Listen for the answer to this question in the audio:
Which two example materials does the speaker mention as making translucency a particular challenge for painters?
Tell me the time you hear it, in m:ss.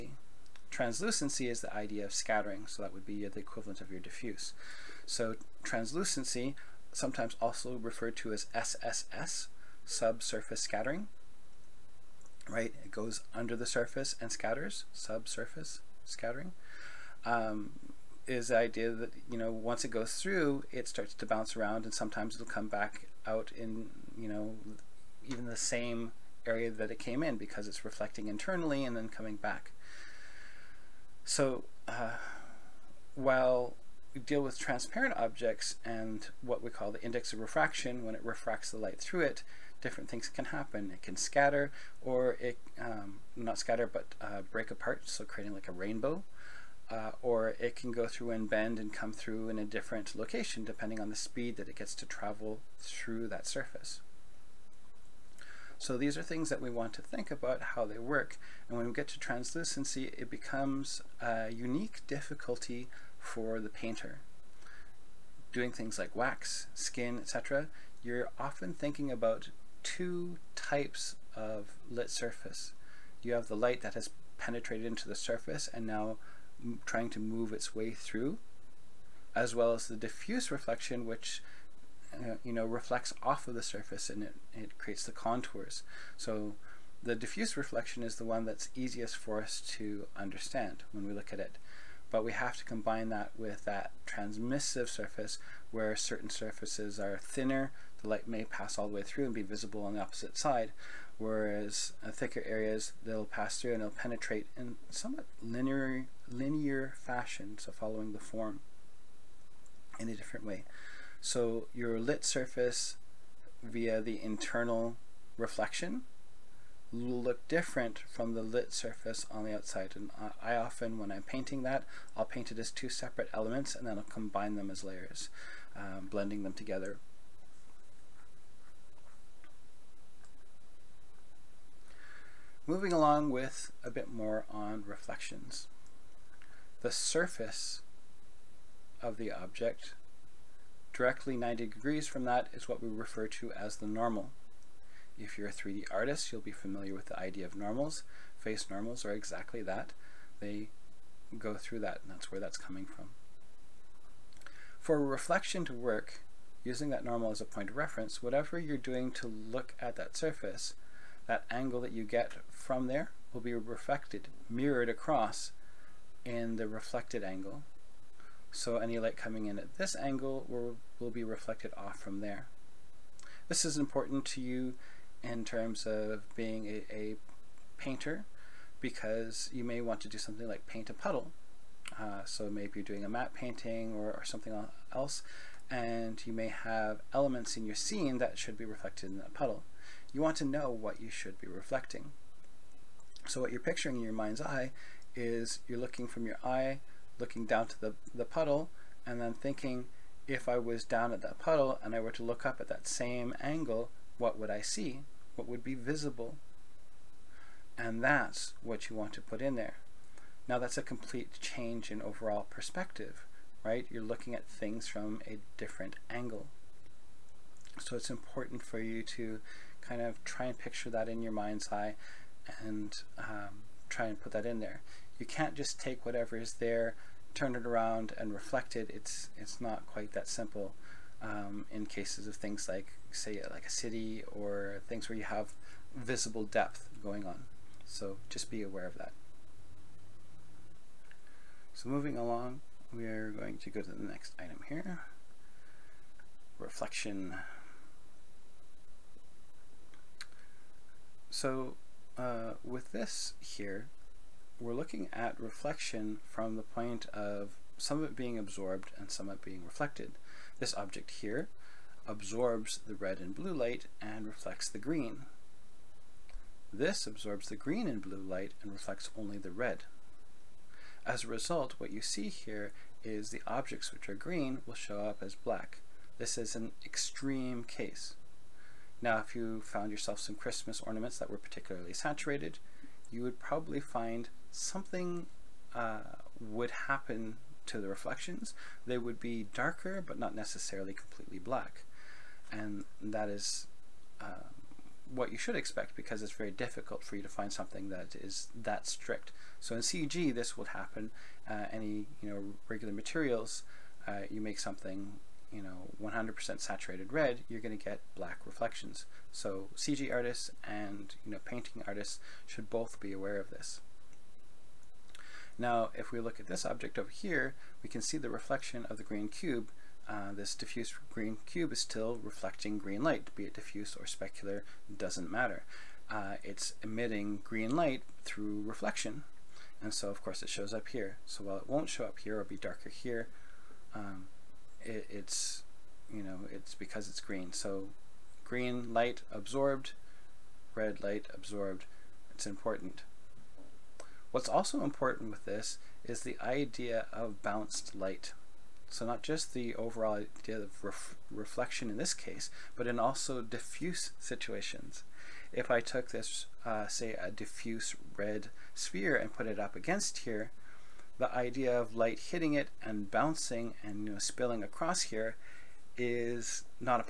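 1:06.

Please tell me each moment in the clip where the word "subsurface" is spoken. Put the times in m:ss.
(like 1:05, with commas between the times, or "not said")
0:09, 0:14.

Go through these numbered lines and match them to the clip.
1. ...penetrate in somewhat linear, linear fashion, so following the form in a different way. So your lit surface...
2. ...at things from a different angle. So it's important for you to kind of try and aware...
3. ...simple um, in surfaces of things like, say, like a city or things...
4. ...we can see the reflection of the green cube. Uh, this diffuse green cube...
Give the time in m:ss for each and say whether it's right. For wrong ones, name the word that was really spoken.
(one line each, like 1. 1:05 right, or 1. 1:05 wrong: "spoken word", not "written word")
1. 1:43 right
2. 3:34 wrong: "picture", not "aware"
3. 3:50 wrong: "cases", not "surfaces"
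4. 5:17 right.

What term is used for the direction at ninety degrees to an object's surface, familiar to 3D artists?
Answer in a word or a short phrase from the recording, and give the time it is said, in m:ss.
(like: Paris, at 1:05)
the normal, at 2:23.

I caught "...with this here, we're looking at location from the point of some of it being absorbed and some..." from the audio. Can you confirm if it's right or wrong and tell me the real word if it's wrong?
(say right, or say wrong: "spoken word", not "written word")
wrong: "reflection", not "location".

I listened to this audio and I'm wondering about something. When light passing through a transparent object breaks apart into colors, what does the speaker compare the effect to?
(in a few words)
a rainbow.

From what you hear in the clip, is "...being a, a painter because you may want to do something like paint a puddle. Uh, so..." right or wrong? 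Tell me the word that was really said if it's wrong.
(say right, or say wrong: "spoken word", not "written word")
right.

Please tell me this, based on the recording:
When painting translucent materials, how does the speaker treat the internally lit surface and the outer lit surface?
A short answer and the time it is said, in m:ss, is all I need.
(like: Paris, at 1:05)
as two separate elements, at 2:02.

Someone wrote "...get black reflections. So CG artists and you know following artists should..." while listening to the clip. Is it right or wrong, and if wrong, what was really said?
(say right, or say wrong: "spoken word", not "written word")
wrong: "painting", not "following".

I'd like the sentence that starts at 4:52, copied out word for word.
And that is uh, what you should expect because it's very difficult for you to find something that is that strict.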